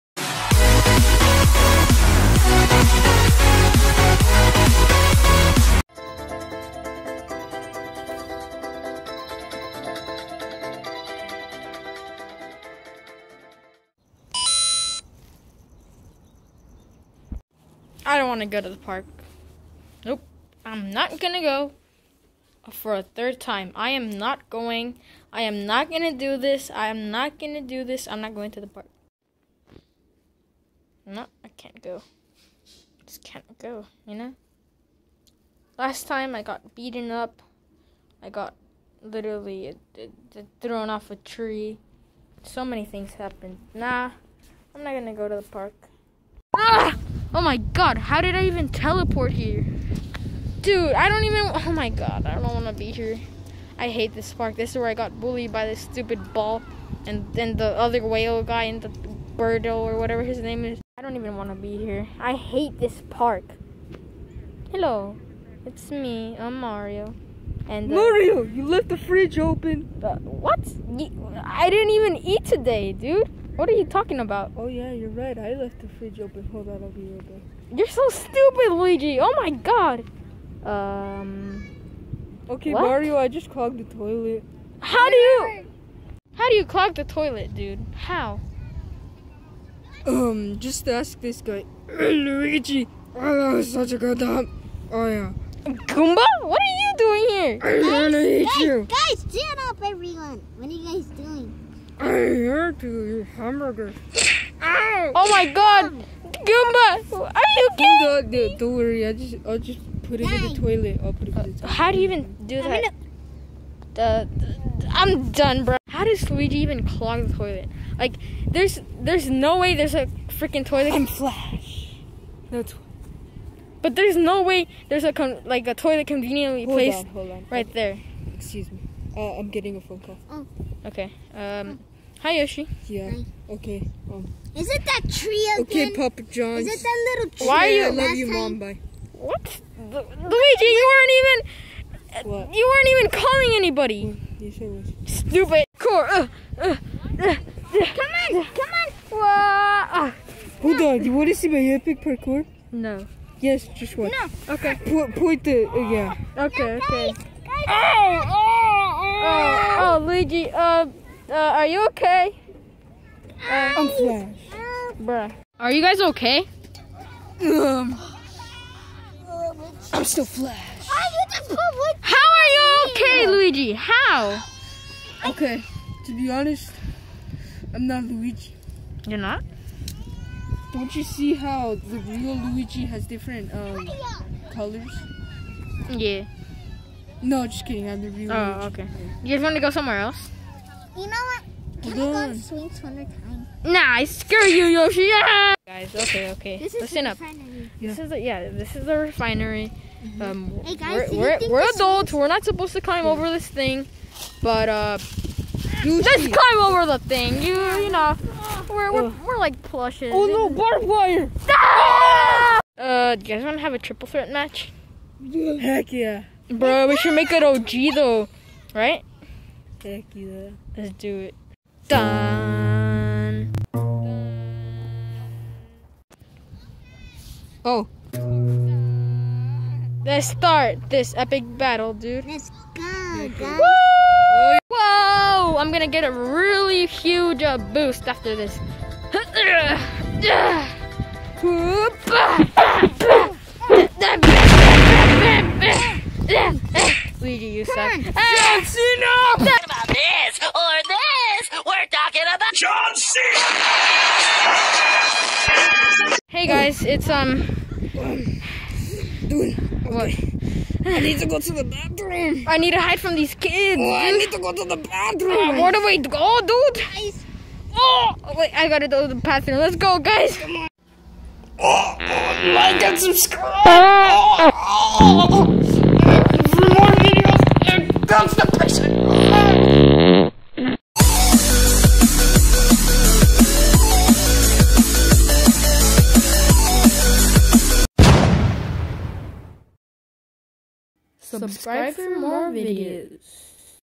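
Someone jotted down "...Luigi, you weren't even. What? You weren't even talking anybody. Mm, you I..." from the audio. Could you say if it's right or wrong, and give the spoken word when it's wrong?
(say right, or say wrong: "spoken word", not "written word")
wrong: "calling", not "talking".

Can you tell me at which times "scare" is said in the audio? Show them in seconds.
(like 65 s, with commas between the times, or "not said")
194 s.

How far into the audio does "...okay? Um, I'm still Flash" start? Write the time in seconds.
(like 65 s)
166 s.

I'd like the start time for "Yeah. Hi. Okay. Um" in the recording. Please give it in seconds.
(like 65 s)
132 s.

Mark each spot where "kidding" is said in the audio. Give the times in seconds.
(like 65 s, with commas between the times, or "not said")
107 s, 187 s.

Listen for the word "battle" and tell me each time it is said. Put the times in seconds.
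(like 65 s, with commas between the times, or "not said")
231 s.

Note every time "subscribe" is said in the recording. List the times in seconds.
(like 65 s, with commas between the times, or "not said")
272 s, 291 s.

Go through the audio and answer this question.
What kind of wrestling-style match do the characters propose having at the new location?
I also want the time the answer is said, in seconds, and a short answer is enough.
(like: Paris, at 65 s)
Triple threat match, at 213 s.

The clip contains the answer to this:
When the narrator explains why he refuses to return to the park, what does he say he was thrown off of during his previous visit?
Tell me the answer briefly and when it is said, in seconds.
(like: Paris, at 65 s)
A tree, at 40 s.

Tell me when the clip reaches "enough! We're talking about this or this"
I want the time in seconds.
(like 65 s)
248 s.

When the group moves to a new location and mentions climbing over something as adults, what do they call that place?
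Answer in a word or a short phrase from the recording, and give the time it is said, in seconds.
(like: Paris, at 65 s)
The refinery, at 198 s.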